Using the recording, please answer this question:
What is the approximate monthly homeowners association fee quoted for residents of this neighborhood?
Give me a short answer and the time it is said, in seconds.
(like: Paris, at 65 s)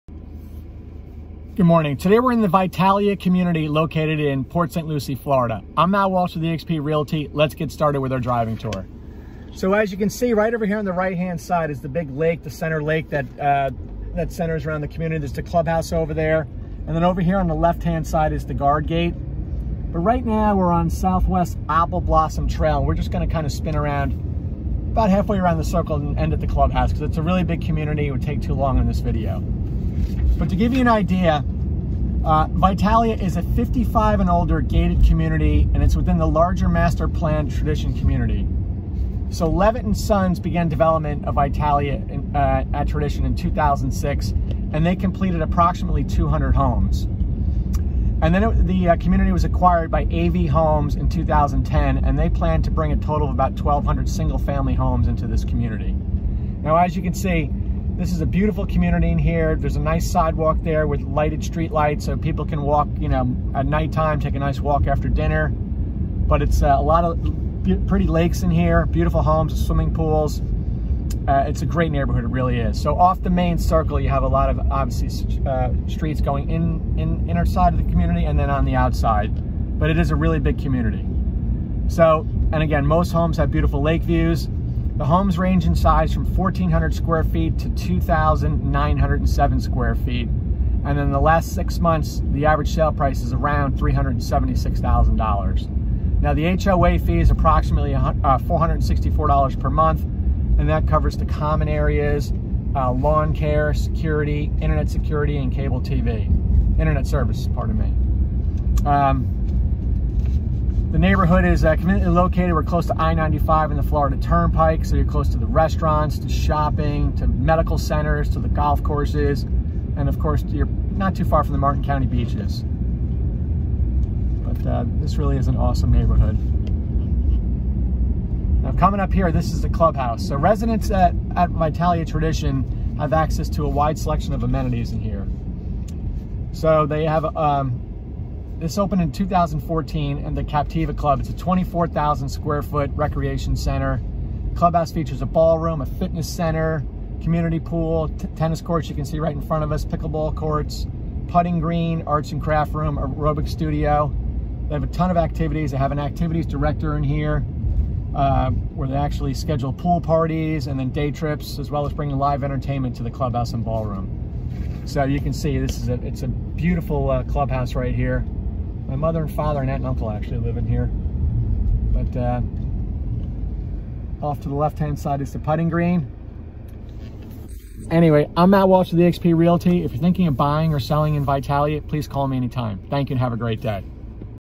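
$464, at 98 s.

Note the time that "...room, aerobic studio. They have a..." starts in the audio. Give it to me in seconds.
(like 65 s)
152 s.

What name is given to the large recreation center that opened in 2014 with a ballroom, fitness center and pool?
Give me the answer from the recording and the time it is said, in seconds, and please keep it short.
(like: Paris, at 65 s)
Captiva Club, at 140 s.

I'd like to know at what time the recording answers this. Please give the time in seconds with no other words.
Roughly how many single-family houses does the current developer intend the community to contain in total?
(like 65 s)
53 s.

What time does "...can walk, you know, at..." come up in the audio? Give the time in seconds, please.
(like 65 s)
62 s.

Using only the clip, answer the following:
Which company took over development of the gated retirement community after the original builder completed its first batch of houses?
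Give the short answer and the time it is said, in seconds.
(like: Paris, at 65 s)
AV Homes, at 50 s.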